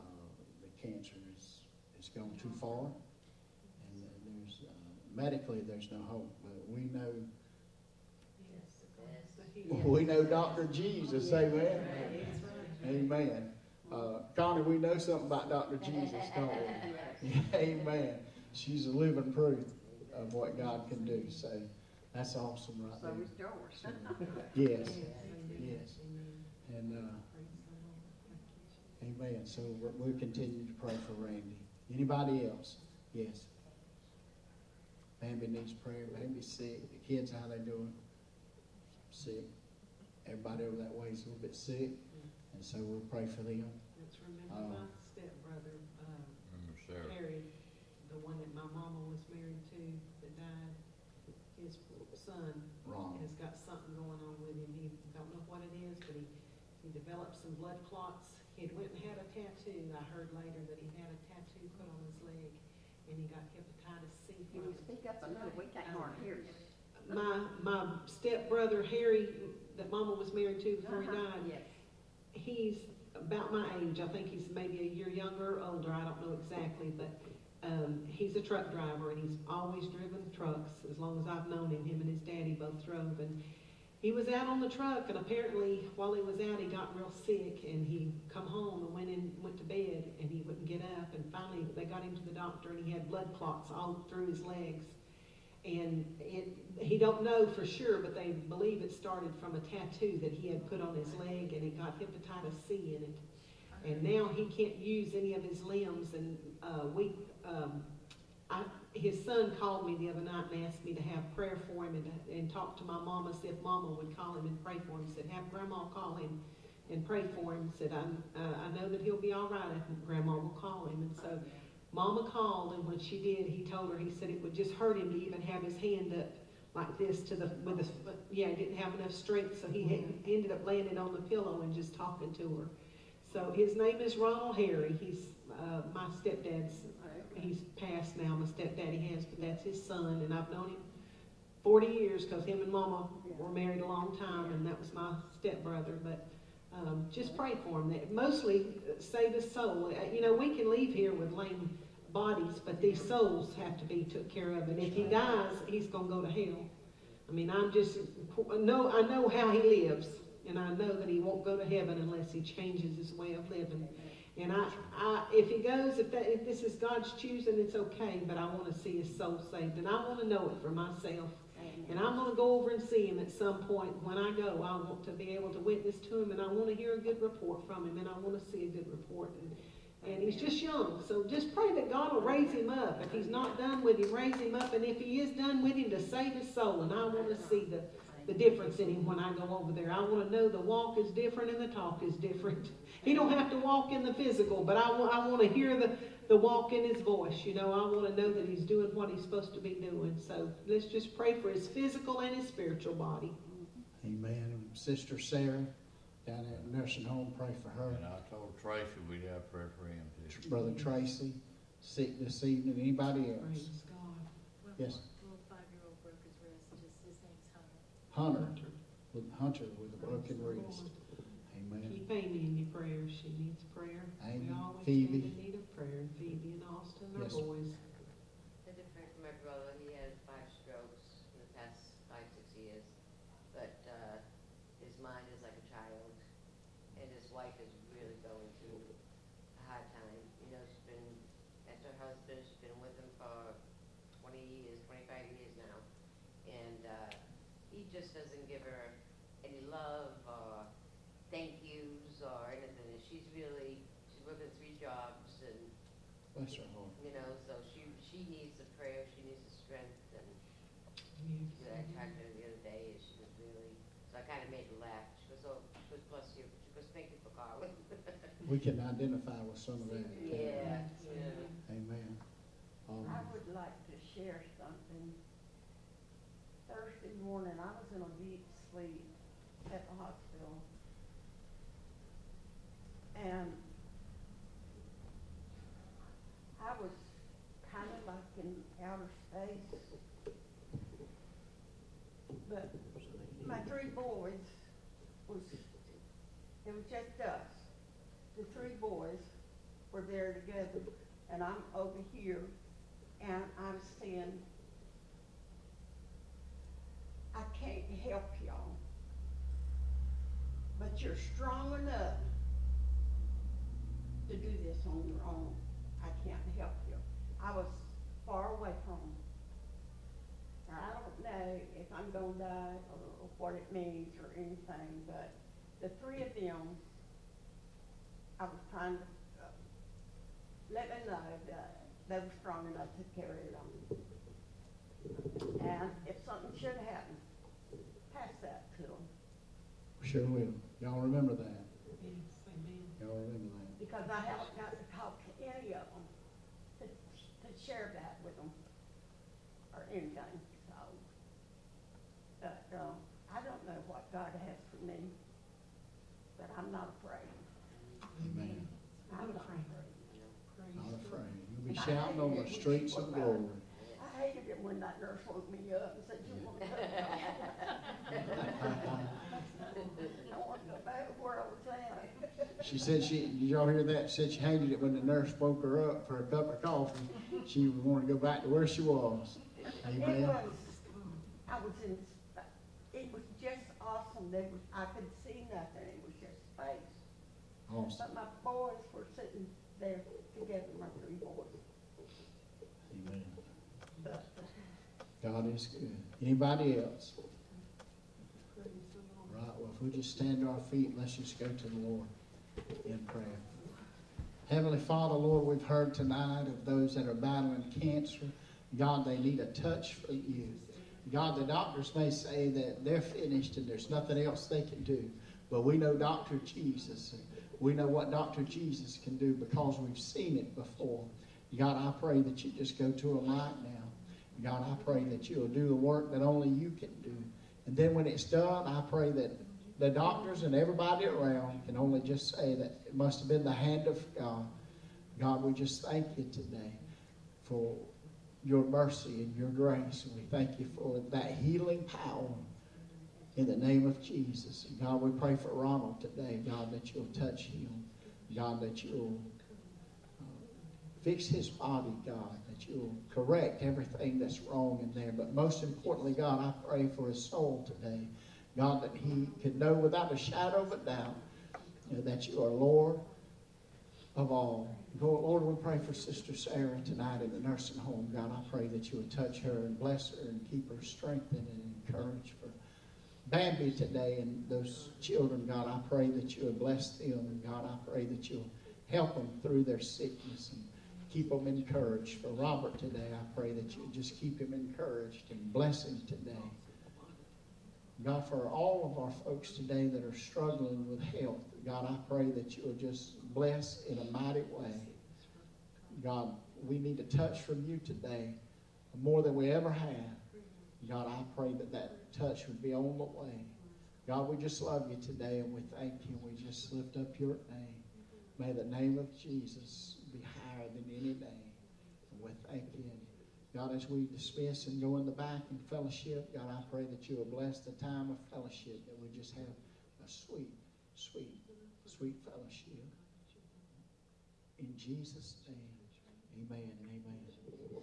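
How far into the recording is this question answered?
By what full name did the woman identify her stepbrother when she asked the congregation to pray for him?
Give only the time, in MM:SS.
02:14.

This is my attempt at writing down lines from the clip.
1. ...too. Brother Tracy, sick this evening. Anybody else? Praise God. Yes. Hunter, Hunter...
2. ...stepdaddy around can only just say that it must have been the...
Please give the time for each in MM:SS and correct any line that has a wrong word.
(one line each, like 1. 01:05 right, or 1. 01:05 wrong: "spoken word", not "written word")
1. 03:30 right
2. 07:10 wrong: "everybody", not "stepdaddy".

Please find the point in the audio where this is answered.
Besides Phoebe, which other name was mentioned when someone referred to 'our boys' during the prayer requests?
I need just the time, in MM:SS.
03:46.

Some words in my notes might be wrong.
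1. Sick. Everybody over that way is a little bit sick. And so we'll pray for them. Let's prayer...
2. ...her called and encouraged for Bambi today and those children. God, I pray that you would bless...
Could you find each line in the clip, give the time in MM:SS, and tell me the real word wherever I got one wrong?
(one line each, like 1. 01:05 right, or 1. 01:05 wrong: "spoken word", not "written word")
1. 00:39 wrong: "remember", not "prayer"
2. 07:50 wrong: "strengthened", not "called".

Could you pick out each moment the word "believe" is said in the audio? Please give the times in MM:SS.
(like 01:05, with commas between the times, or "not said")
01:38.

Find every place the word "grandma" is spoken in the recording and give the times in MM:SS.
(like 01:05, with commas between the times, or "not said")
01:55, 02:00.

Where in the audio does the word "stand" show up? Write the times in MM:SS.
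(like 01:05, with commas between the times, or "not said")
03:45, 06:40.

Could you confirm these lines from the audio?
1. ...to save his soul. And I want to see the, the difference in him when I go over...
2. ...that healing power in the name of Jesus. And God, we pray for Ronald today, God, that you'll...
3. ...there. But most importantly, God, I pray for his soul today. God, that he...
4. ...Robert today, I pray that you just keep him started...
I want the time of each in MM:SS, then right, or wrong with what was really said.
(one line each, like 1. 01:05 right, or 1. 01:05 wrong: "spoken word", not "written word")
1. 03:05 right
2. 07:21 right
3. 07:35 right
4. 08:02 wrong: "encouraged", not "started".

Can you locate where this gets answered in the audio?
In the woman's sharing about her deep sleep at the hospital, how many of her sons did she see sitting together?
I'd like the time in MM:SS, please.
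04:58.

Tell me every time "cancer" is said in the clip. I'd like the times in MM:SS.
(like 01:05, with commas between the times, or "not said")
00:00, 06:47.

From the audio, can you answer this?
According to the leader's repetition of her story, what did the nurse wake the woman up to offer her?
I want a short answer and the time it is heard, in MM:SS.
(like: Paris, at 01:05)
A cup of coffee, at 06:16.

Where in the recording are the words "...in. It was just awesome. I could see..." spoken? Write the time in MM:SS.
06:21.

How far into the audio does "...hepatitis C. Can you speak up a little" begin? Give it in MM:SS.
01:03.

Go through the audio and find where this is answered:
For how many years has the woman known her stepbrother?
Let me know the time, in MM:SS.
02:21.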